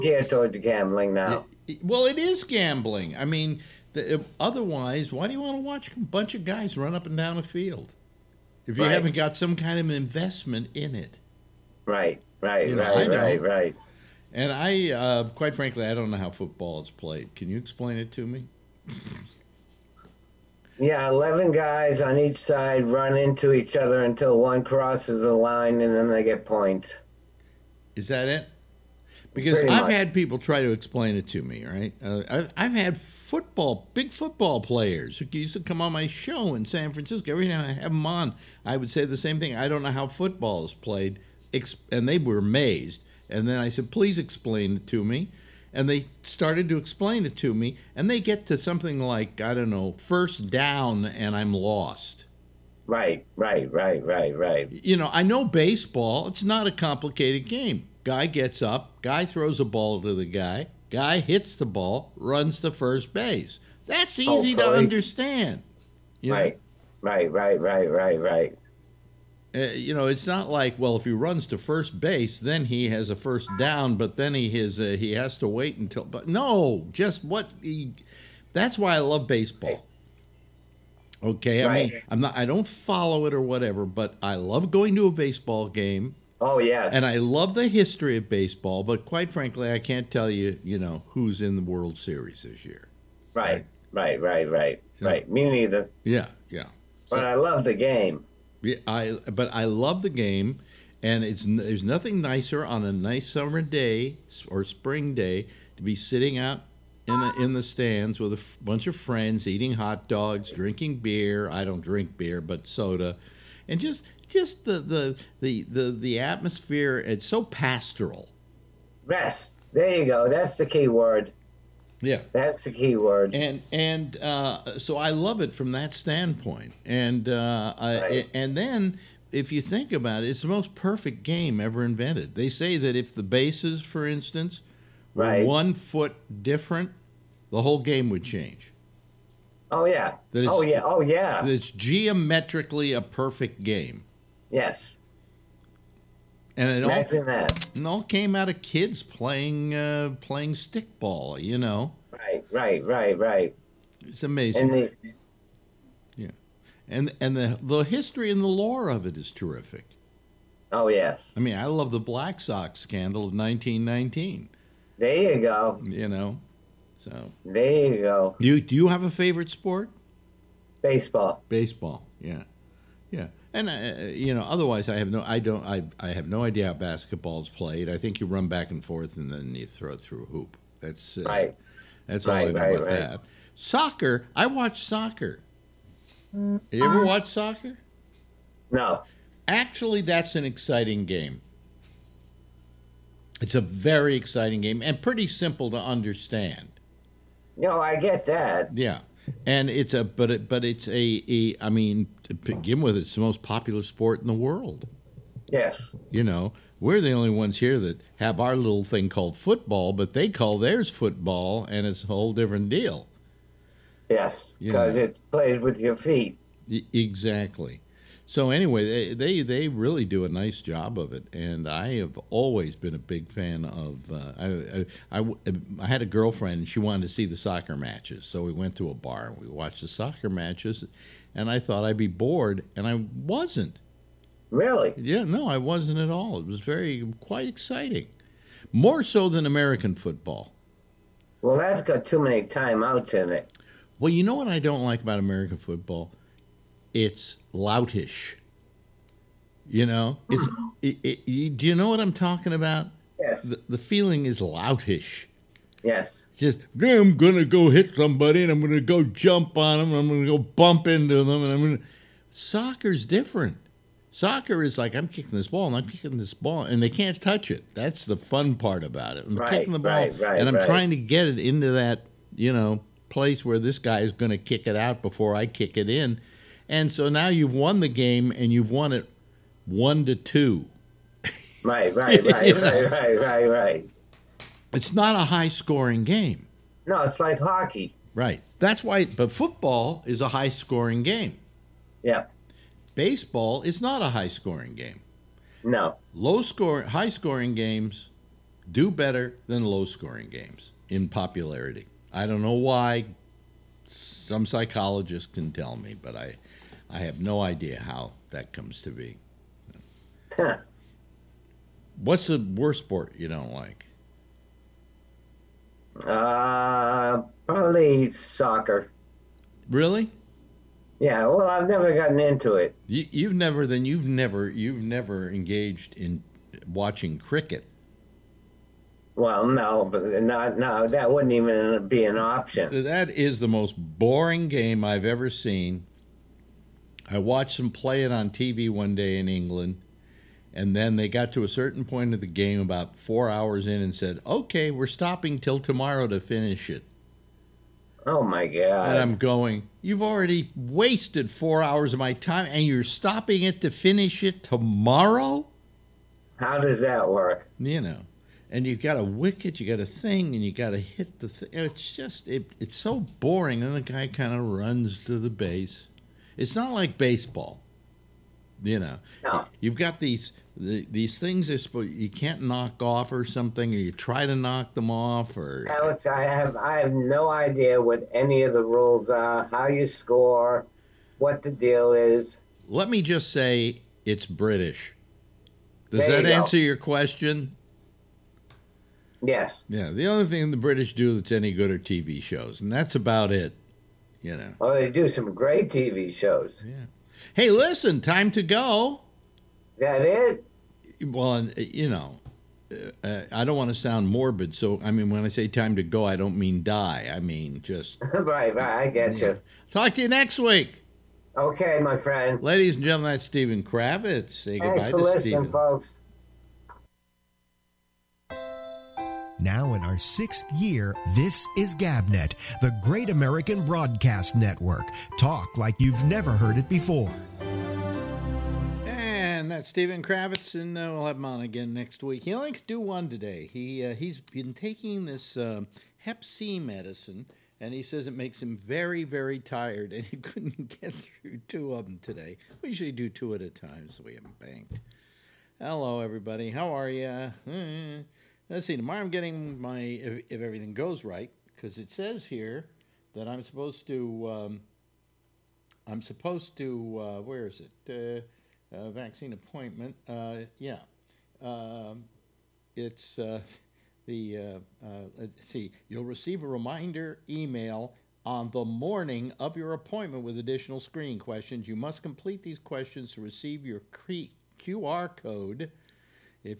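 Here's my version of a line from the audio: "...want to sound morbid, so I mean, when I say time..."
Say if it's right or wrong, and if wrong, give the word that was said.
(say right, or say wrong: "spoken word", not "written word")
right.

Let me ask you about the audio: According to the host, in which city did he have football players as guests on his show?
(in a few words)
San Francisco.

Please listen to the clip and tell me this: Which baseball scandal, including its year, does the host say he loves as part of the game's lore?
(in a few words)
Black Sox scandal of 1919.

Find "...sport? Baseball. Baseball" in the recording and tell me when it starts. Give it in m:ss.
2:49.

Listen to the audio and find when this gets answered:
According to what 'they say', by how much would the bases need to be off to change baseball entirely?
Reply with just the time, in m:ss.
2:15.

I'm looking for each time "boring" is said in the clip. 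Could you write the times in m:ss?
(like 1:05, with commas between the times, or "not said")
5:33, 6:03.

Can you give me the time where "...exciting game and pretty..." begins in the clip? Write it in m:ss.
3:14.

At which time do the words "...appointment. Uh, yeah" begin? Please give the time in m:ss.
7:39.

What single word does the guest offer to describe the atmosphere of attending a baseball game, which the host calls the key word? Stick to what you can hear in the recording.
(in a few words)
Pastoral.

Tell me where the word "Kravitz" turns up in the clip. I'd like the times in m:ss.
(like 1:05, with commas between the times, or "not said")
6:53, 7:10.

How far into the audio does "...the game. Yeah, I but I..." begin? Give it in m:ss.
1:37.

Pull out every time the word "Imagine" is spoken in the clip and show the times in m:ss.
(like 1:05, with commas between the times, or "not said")
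2:26.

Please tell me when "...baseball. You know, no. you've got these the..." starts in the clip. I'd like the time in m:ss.
6:06.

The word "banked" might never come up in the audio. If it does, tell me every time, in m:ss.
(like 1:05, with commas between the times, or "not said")
7:24.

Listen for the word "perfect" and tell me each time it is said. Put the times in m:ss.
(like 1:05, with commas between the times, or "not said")
2:10, 2:23.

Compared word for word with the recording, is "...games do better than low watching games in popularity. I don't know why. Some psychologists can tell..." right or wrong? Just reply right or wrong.
wrong.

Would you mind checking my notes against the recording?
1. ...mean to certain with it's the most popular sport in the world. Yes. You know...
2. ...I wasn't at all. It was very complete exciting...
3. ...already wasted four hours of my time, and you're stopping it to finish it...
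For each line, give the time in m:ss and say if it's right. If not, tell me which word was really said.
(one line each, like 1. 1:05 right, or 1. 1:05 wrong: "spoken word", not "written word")
1. 3:21 wrong: "begin", not "certain"
2. 3:55 wrong: "quite", not "complete"
3. 5:50 right.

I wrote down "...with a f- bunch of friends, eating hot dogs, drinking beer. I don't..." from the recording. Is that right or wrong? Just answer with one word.
right.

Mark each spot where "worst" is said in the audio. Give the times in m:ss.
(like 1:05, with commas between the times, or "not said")
5:12.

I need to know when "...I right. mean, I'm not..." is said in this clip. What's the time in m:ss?
1:21.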